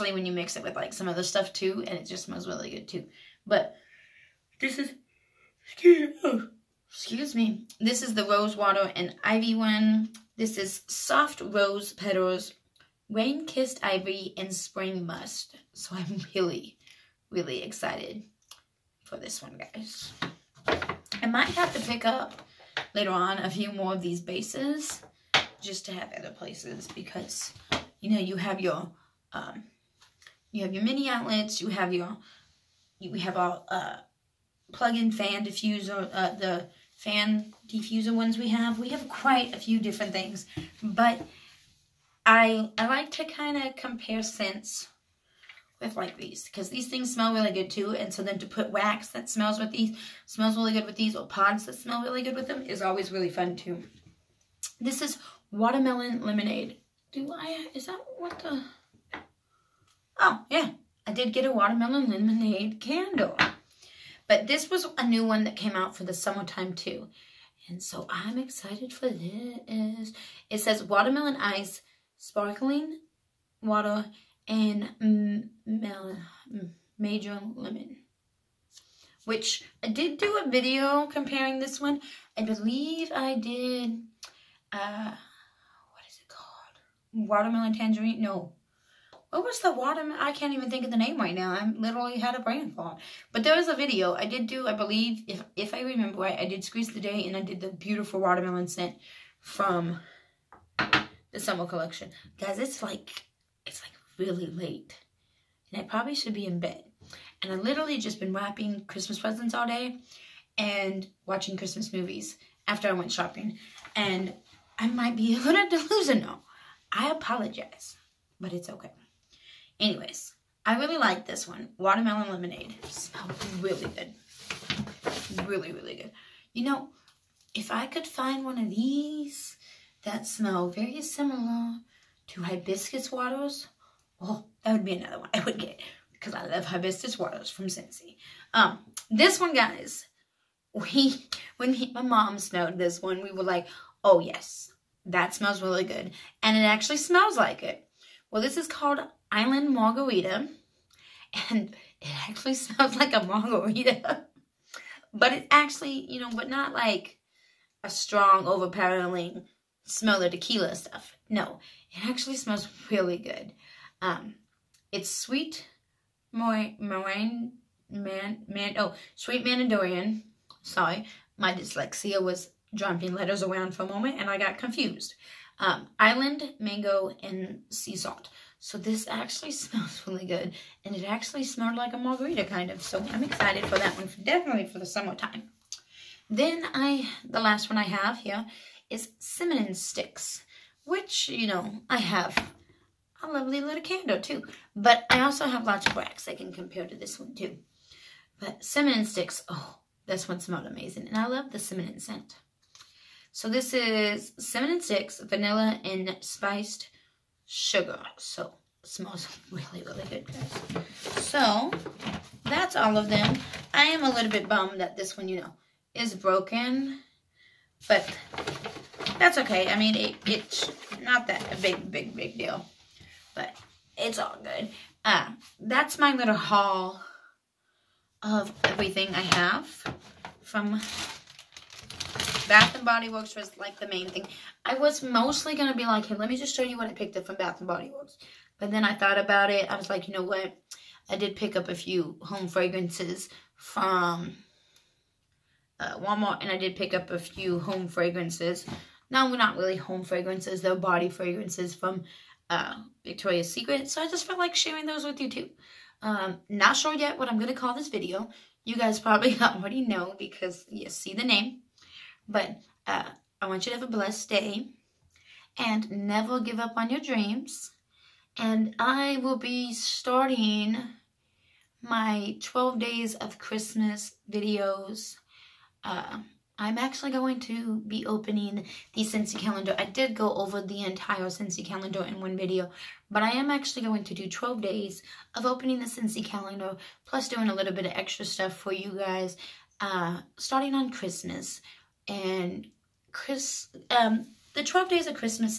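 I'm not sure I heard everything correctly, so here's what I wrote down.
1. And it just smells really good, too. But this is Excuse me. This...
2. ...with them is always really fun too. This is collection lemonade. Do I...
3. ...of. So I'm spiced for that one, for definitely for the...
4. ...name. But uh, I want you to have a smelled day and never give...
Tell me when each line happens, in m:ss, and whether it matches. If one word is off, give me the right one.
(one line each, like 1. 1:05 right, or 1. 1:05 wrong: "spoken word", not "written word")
1. 0:01 right
2. 0:52 wrong: "watermelon", not "collection"
3. 3:02 wrong: "excited", not "spiced"
4. 4:21 wrong: "blessed", not "smelled".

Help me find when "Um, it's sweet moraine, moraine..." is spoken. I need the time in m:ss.
2:44.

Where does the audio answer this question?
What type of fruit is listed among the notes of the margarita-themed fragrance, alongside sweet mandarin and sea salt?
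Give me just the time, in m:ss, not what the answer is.
2:55.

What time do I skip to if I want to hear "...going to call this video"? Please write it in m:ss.
4:17.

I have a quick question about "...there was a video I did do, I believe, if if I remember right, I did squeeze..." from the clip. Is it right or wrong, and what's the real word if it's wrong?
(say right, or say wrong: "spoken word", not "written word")
right.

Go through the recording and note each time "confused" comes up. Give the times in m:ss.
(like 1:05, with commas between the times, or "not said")
2:54.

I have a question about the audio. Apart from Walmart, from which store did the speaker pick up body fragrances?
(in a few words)
Victoria's Secret.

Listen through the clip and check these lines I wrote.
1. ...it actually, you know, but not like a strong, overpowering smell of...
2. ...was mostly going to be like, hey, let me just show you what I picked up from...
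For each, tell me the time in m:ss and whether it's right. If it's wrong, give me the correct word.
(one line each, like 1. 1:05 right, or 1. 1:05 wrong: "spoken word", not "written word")
1. 2:35 right
2. 3:54 right.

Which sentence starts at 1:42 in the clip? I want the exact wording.
Guys, it's like it's like really late.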